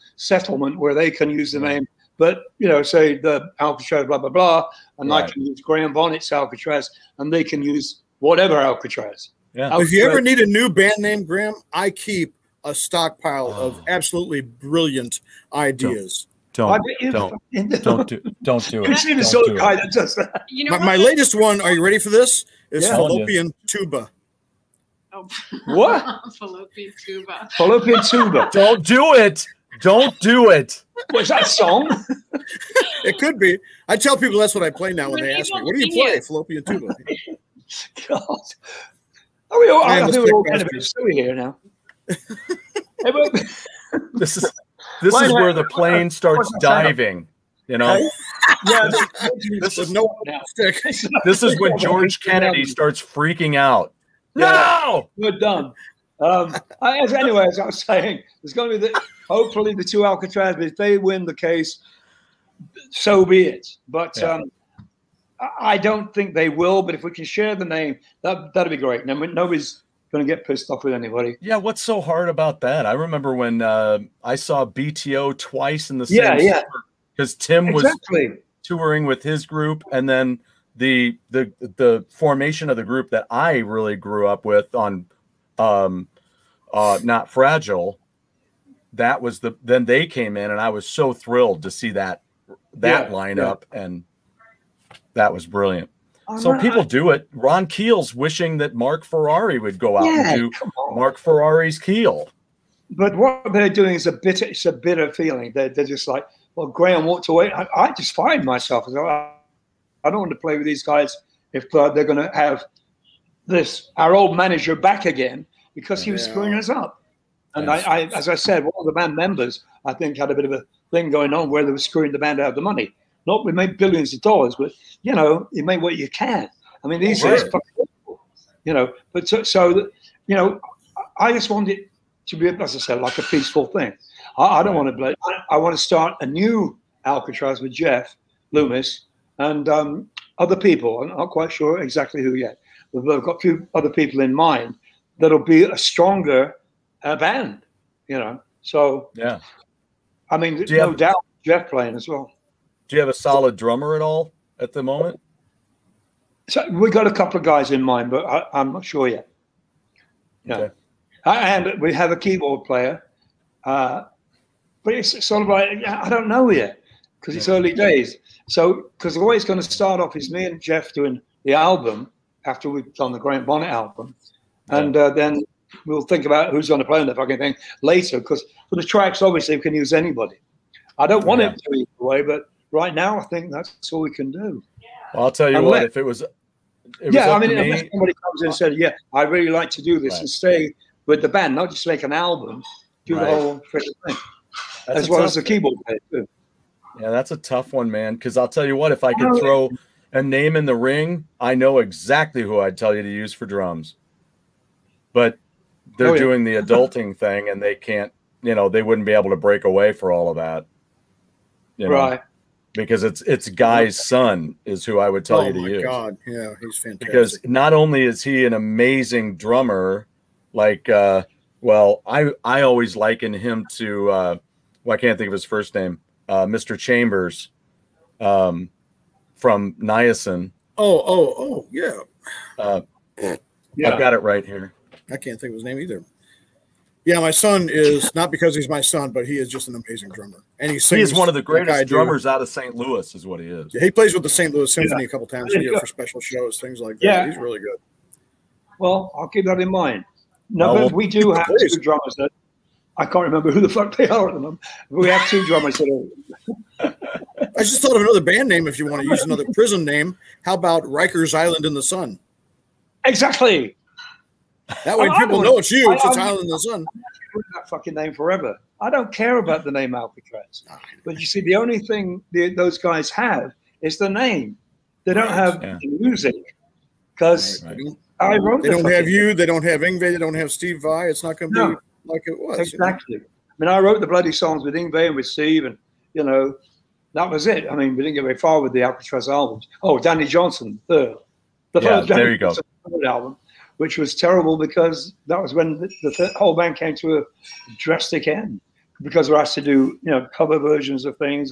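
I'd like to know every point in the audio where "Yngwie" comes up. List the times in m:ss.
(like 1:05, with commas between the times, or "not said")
4:39, 4:44.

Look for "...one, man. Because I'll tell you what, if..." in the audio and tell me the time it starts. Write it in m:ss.
3:17.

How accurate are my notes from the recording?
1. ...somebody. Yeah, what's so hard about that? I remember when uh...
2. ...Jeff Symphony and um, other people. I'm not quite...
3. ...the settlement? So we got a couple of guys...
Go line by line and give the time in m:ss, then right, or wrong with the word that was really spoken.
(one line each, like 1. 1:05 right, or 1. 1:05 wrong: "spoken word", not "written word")
1. 1:10 wrong: "anybody", not "somebody"
2. 2:17 wrong: "Loomis", not "Symphony"
3. 2:34 wrong: "moment", not "settlement".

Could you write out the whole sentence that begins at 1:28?
That was the then they came in, and I was so thrilled to see that that yeah, lineup, yeah.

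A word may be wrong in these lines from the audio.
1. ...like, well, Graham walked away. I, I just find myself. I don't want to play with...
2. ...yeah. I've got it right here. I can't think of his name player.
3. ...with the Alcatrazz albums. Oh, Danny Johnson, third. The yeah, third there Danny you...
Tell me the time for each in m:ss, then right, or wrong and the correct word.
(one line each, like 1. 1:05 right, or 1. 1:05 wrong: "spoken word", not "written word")
1. 1:46 right
2. 3:53 wrong: "either", not "player"
3. 4:48 right.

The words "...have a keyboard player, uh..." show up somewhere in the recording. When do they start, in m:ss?
2:41.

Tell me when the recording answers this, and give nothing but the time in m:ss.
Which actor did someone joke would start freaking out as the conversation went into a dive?
0:51.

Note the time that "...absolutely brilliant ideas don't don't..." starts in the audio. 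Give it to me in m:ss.
0:13.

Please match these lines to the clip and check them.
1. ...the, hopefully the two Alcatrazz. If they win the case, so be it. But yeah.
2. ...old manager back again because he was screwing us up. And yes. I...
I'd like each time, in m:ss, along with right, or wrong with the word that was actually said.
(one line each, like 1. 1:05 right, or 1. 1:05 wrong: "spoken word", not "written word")
1. 0:58 right
2. 1:54 right.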